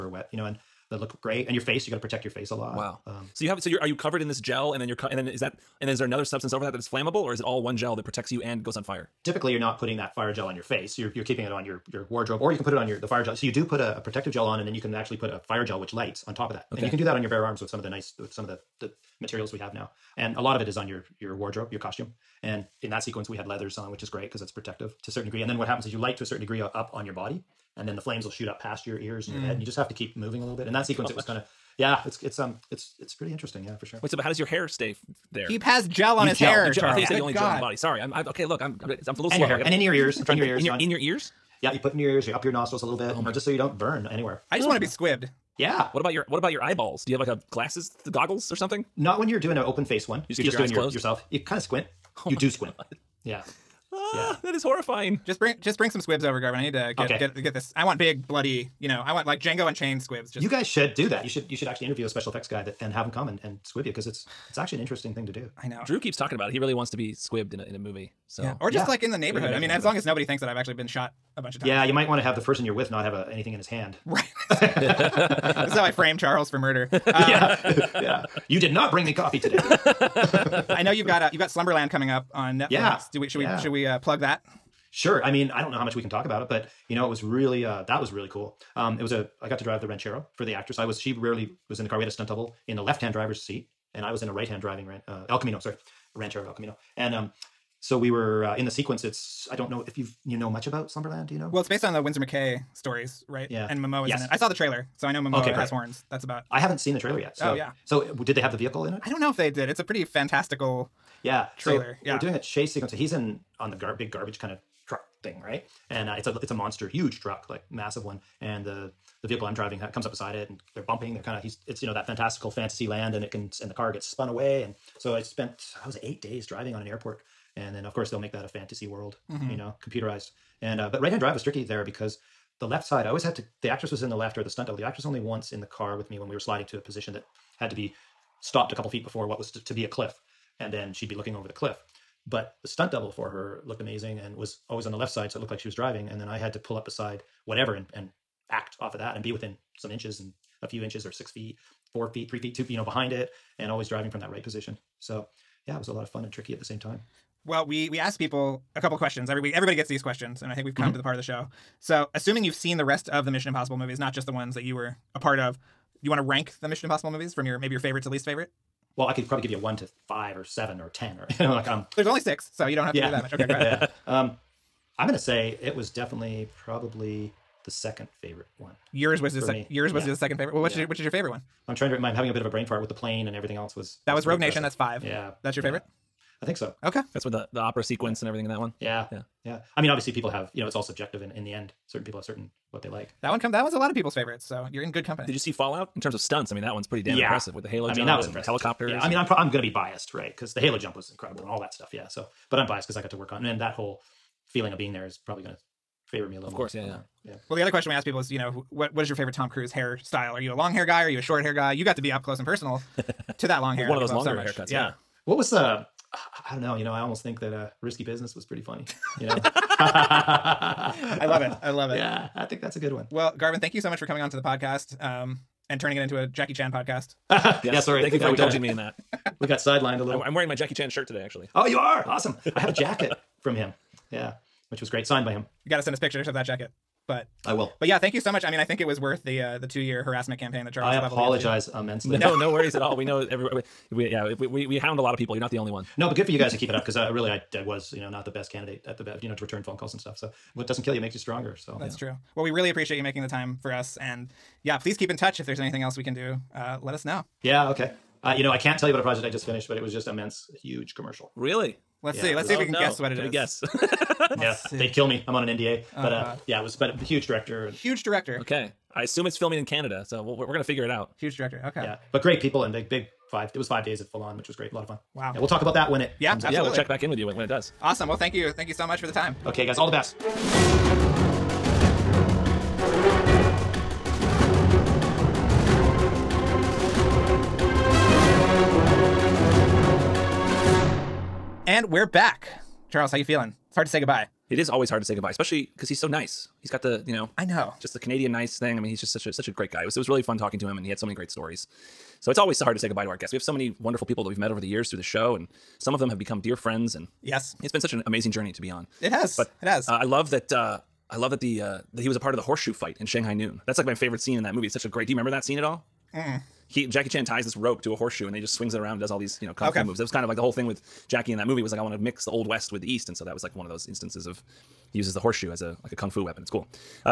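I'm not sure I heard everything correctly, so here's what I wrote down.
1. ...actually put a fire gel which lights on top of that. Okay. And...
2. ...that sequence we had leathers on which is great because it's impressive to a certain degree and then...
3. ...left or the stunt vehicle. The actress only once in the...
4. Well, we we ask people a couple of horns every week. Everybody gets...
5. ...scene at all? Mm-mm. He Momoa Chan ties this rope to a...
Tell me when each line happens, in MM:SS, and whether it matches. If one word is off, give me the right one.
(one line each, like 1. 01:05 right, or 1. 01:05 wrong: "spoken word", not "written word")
1. 00:14 right
2. 00:22 wrong: "protective", not "impressive"
3. 02:14 wrong: "double", not "vehicle"
4. 02:37 wrong: "questions", not "horns"
5. 05:15 wrong: "Jackie", not "Momoa".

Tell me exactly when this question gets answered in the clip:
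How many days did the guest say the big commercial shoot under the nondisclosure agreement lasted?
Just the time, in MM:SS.
04:33.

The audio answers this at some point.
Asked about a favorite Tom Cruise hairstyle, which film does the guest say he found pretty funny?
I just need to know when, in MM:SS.
03:37.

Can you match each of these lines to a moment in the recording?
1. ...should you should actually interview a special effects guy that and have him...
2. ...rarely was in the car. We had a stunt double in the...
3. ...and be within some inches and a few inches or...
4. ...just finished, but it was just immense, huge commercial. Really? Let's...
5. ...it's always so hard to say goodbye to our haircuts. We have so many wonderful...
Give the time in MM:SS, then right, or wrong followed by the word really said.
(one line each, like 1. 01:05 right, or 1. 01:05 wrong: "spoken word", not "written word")
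1. 01:01 right
2. 01:31 right
3. 02:29 right
4. 04:19 right
5. 05:02 wrong: "guests", not "haircuts".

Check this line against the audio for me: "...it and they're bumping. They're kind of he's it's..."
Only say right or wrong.
right.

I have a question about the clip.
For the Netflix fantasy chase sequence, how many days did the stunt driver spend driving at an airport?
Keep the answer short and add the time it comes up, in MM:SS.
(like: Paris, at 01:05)
8, at 02:06.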